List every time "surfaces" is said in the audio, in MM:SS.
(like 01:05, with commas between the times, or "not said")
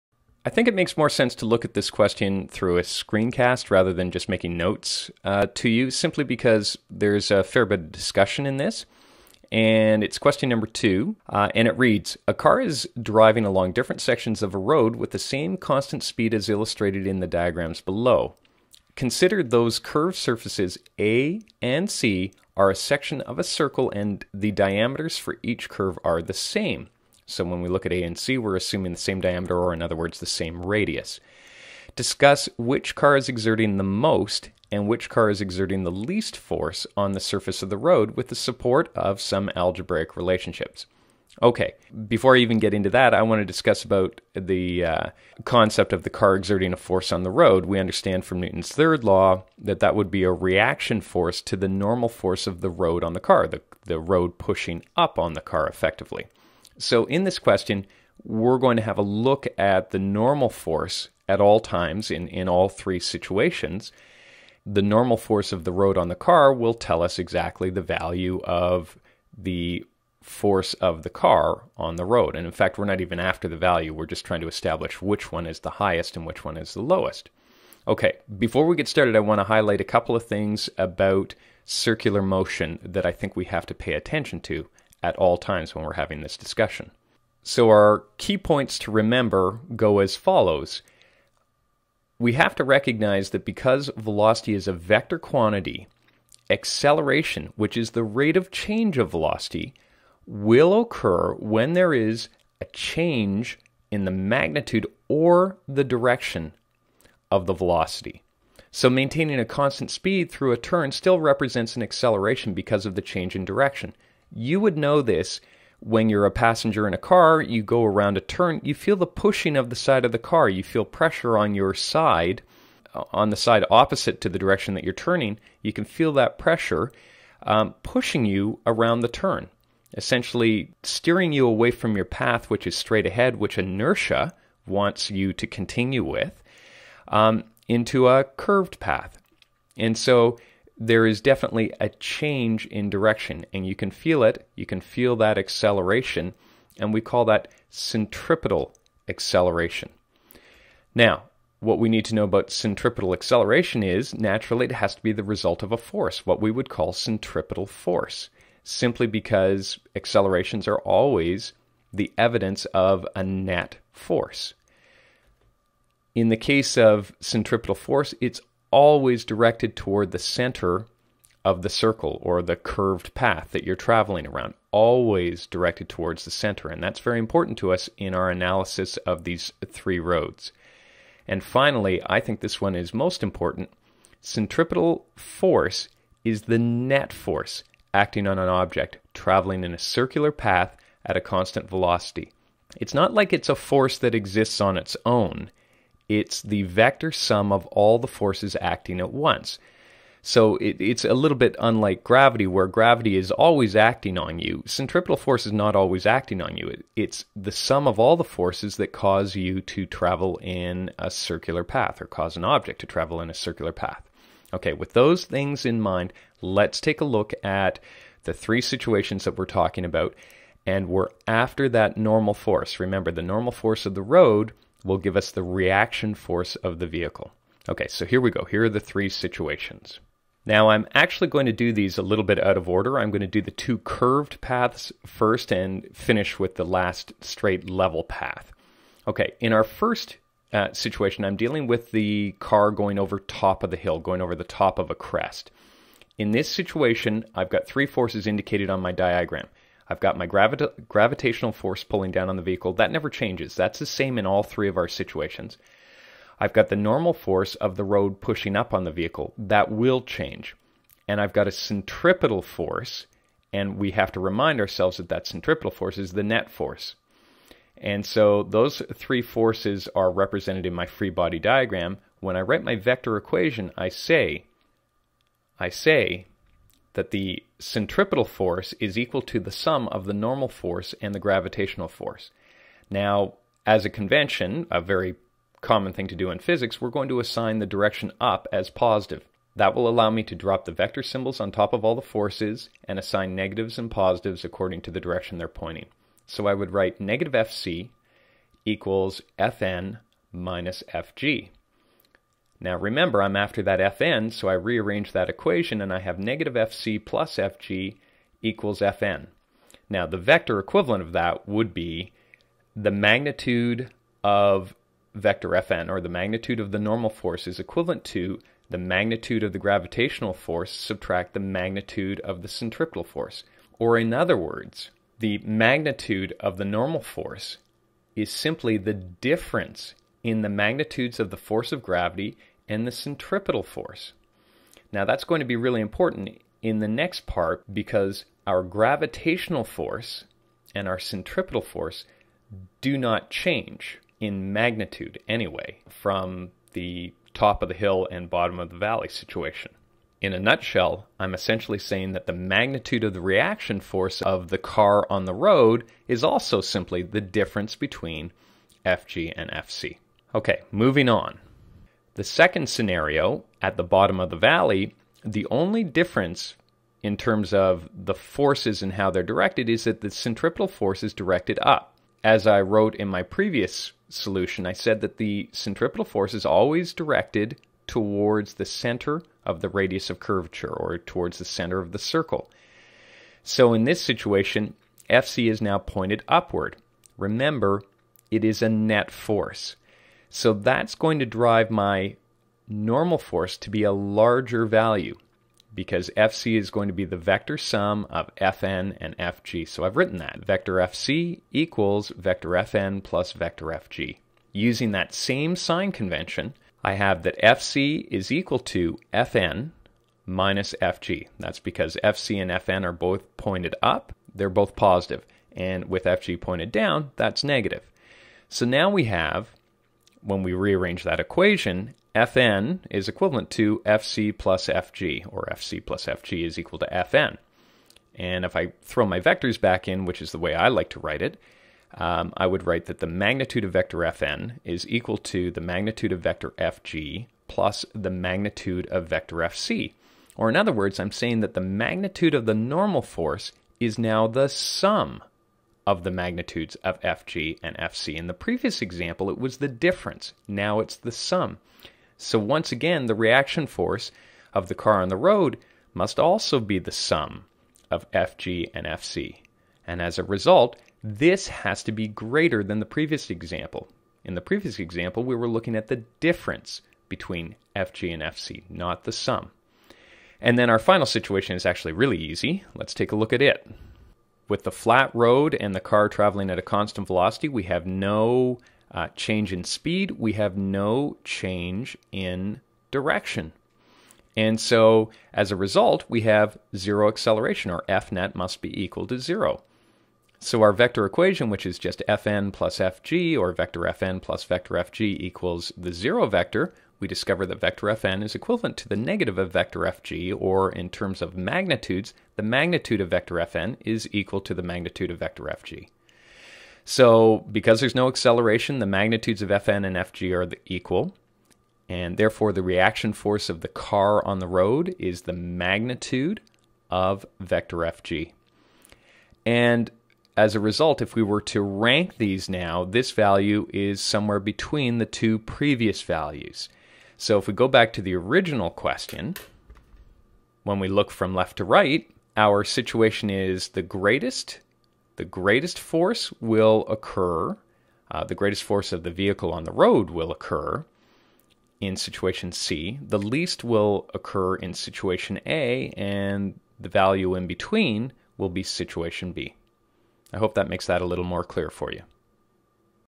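00:20, 00:37.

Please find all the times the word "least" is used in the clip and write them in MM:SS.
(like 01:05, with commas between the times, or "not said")
00:35, 09:03.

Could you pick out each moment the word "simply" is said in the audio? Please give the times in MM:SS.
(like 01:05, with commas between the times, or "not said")
00:05, 02:38, 05:28, 05:56.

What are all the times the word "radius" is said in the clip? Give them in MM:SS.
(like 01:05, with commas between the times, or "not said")
00:30, 06:19.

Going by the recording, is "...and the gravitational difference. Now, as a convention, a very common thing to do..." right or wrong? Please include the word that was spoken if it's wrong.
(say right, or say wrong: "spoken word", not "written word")
wrong: "force", not "difference".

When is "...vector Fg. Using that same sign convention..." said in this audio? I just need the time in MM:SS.
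06:43.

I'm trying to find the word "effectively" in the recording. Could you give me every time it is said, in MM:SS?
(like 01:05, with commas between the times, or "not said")
00:55.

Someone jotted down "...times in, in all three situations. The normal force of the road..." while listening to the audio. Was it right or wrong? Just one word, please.
right.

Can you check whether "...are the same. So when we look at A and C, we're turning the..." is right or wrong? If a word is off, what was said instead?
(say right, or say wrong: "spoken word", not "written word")
wrong: "assuming", not "turning".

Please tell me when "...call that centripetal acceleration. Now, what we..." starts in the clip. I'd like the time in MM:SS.
02:27.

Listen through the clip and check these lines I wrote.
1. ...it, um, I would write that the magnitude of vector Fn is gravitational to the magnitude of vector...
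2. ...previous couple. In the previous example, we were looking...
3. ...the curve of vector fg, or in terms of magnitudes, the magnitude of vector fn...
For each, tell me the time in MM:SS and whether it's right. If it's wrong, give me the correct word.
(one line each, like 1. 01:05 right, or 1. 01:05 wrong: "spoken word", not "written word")
1. 07:11 wrong: "equal", not "gravitational"
2. 07:42 wrong: "example", not "couple"
3. 08:18 wrong: "negative", not "curve".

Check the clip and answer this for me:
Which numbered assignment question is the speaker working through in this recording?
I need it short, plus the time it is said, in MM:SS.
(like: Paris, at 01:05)
2, at 00:10.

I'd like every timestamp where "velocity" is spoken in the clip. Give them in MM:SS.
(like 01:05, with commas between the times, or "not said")
01:33, 01:39, 01:47, 03:11, 07:57.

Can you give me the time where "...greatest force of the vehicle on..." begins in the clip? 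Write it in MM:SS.
08:58.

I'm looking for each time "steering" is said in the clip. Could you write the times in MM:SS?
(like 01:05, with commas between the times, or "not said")
02:10.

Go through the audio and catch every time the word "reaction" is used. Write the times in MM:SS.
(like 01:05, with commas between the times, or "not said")
00:50, 03:45, 05:53, 07:33, 08:32.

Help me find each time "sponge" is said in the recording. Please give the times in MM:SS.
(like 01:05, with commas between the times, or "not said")
not said.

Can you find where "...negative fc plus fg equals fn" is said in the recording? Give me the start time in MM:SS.
05:06.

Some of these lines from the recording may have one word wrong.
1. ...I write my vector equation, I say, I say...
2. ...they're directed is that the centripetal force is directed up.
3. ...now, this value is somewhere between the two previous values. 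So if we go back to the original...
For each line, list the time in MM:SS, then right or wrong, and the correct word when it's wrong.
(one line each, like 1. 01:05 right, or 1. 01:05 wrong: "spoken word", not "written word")
1. 04:32 right
2. 06:09 right
3. 08:42 right.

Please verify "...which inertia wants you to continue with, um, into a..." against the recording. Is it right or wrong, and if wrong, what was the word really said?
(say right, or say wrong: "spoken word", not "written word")
right.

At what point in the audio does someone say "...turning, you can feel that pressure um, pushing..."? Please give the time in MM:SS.
02:04.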